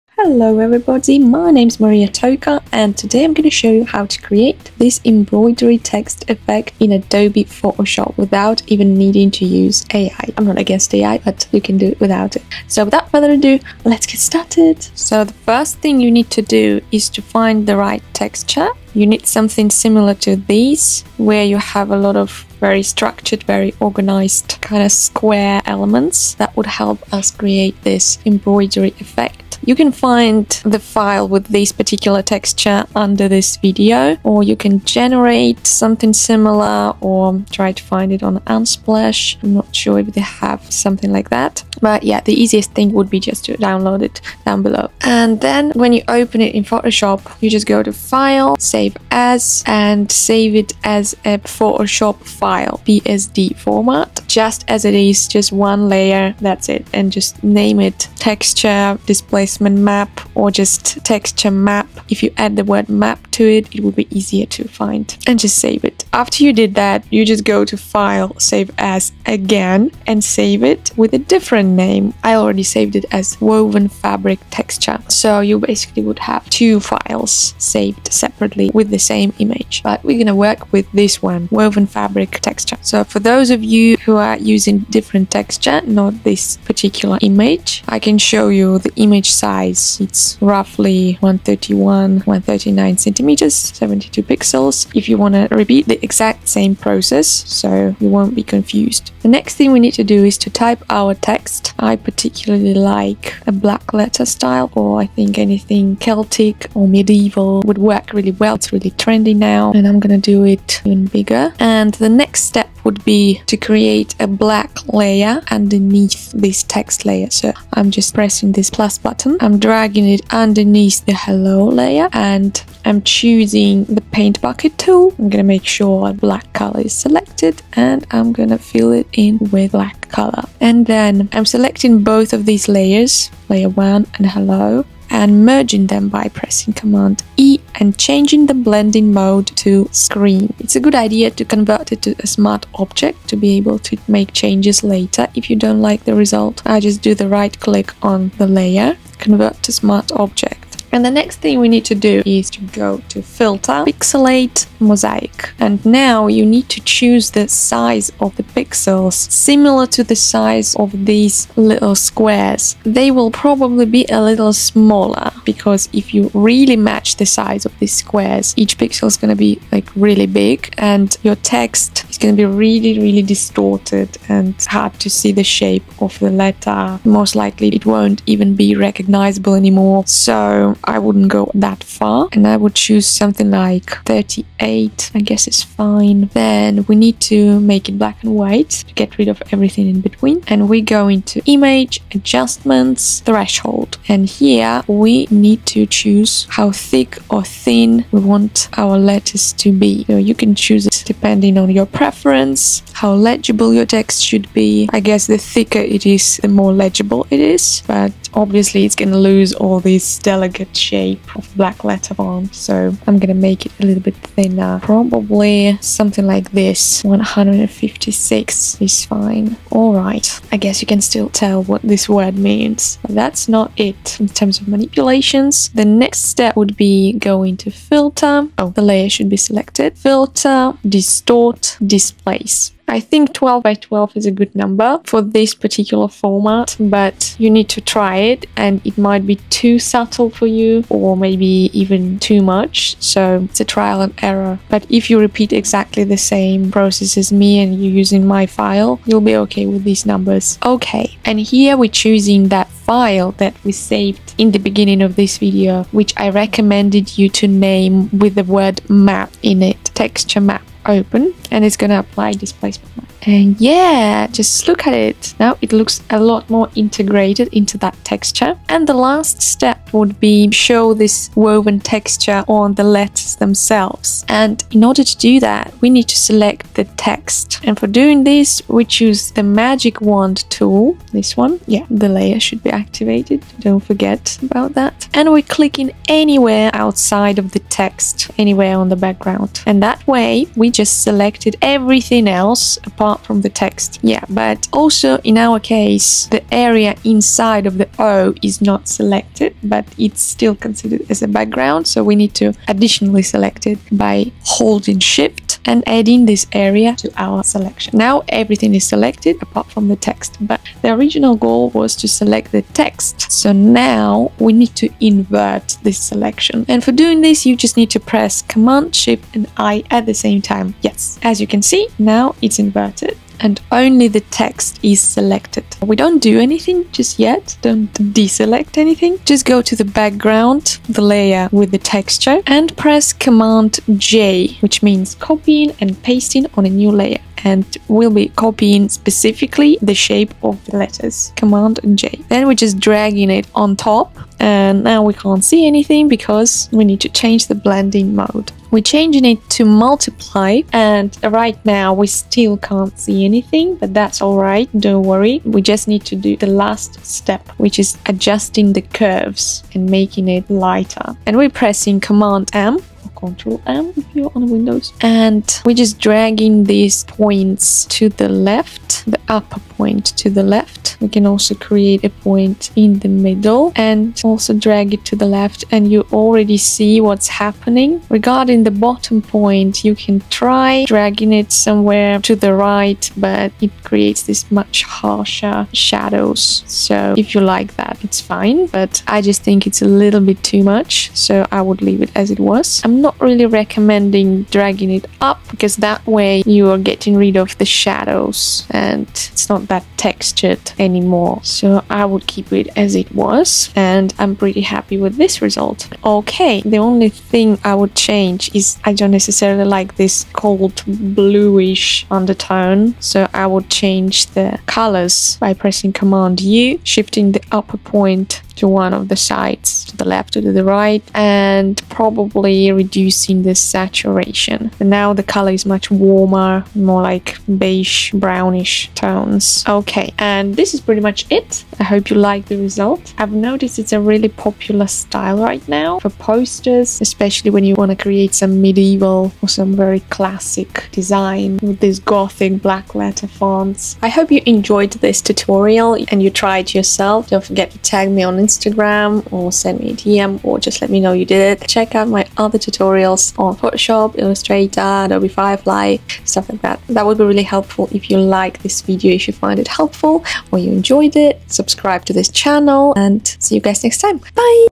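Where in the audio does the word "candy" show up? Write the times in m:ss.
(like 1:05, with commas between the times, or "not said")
not said.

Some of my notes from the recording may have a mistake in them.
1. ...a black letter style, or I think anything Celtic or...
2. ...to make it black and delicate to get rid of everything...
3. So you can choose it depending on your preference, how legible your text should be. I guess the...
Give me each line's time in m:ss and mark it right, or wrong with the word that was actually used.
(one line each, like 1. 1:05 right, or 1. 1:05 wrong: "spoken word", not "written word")
1. 1:43 right
2. 3:07 wrong: "white", not "delicate"
3. 3:20 right.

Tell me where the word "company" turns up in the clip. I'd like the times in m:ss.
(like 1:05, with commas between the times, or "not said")
not said.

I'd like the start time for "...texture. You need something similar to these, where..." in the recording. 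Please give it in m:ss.
0:18.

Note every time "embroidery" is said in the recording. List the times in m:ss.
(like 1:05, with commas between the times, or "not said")
0:05, 0:28.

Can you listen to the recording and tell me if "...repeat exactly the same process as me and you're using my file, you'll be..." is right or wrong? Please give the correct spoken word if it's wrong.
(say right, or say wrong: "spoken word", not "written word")
right.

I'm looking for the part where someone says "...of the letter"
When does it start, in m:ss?
2:56.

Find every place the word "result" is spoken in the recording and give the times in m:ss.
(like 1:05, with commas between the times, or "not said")
2:26, 6:45, 7:12.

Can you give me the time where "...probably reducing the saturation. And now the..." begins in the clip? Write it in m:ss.
7:01.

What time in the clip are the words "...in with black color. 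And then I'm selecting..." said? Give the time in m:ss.
2:09.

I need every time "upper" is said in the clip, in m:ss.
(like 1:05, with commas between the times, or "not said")
6:09, 6:57.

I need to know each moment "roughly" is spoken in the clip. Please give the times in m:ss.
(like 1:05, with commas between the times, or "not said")
1:30.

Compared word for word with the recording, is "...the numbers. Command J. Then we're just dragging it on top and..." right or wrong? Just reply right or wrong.
wrong.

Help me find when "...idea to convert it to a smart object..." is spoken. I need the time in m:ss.
2:20.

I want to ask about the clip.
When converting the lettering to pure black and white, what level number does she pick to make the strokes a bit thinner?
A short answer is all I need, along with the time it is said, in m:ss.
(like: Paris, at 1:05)
156, at 3:37.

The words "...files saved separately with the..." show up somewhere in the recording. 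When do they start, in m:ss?
1:16.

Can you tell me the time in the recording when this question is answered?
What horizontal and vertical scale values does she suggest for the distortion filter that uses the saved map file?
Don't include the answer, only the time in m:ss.
3:53.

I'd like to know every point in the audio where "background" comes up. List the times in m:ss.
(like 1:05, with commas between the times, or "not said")
4:48, 5:01, 5:29.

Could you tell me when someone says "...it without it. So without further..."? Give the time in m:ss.
0:11.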